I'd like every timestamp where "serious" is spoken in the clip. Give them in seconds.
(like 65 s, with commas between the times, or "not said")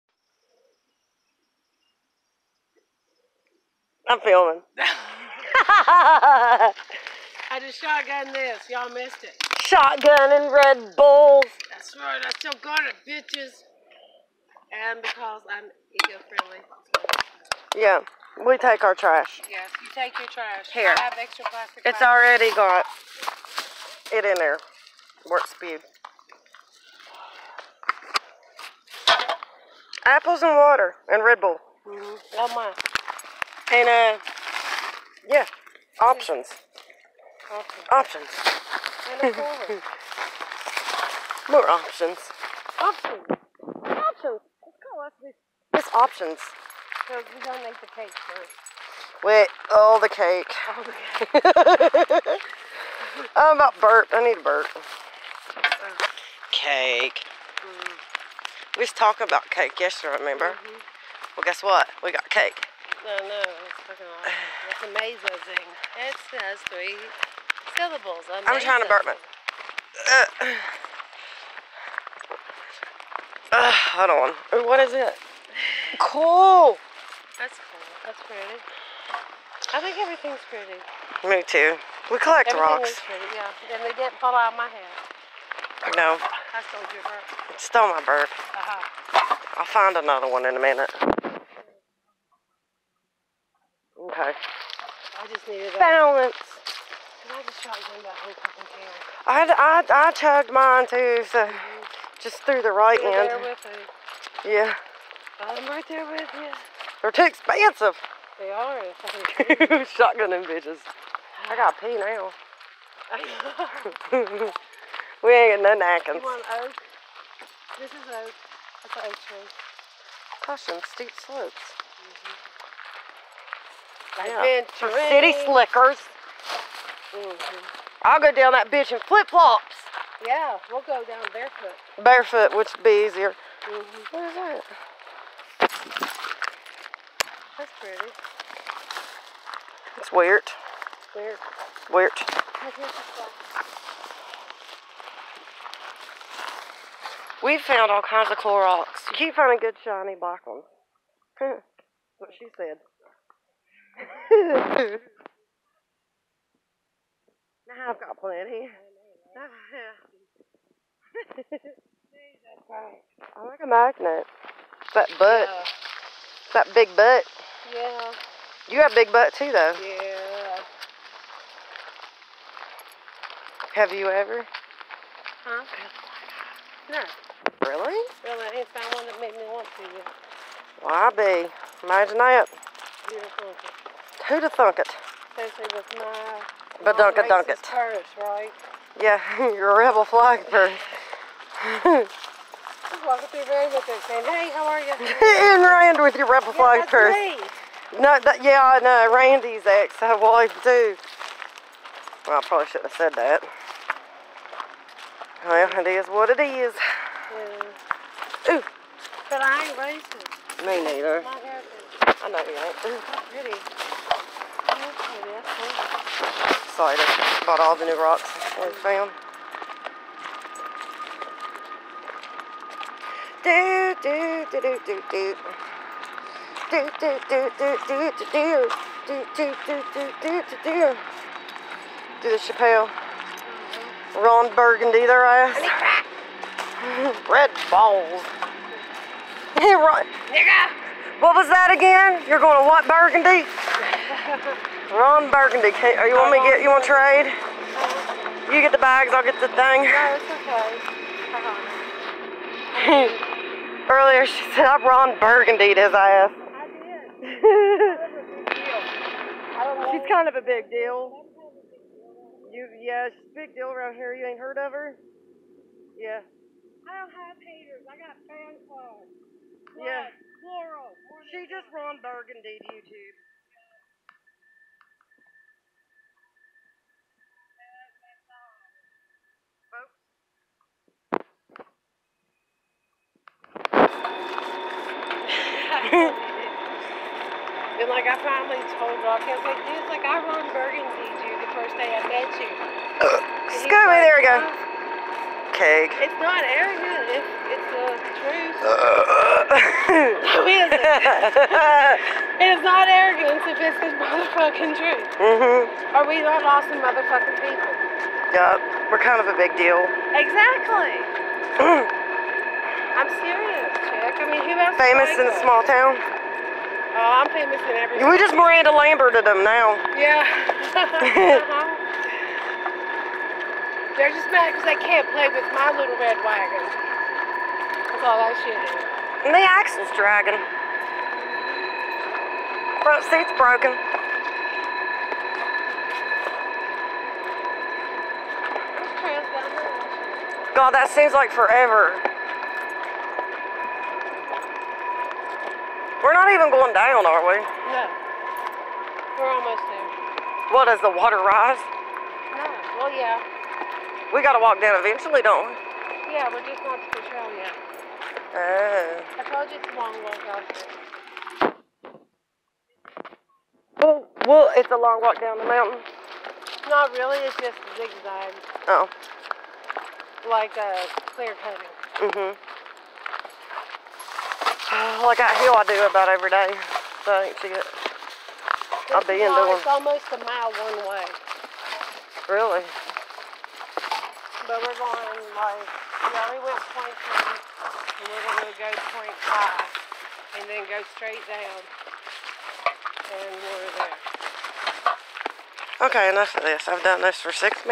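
313 s.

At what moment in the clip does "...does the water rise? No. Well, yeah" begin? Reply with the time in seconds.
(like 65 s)
350 s.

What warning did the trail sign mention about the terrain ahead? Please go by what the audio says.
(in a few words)
Steep slopes.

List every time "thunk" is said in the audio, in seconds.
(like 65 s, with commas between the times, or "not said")
184 s.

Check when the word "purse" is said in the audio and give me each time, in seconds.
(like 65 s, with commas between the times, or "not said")
190 s, 196 s.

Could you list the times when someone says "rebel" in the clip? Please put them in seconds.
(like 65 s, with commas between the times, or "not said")
189 s, 196 s.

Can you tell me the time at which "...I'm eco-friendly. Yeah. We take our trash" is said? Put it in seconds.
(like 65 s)
15 s.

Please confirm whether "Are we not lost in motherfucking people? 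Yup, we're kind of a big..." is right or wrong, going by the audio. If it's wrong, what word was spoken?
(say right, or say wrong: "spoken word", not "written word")
right.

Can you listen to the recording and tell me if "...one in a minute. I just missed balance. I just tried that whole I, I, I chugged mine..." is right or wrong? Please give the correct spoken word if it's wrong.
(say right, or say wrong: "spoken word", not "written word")
wrong: "needed", not "missed".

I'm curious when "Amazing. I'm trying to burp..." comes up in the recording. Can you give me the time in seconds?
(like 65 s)
68 s.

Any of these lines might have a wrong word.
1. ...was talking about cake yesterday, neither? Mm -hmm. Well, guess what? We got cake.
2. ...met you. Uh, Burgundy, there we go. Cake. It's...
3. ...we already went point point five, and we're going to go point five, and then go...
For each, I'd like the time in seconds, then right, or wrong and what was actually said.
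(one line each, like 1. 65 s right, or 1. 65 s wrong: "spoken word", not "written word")
1. 58 s wrong: "remember", not "neither"
2. 292 s wrong: "Scoby", not "Burgundy"
3. 385 s wrong: "two", not "five".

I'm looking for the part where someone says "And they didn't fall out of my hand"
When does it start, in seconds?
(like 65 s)
83 s.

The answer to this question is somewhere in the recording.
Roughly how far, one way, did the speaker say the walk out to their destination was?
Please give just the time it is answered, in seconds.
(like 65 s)
379 s.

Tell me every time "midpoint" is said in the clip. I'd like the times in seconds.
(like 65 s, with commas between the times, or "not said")
not said.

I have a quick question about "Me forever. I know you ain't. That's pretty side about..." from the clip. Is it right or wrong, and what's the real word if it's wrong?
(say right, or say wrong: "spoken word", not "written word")
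wrong: "neither", not "forever".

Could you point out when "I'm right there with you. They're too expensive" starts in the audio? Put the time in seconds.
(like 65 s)
105 s.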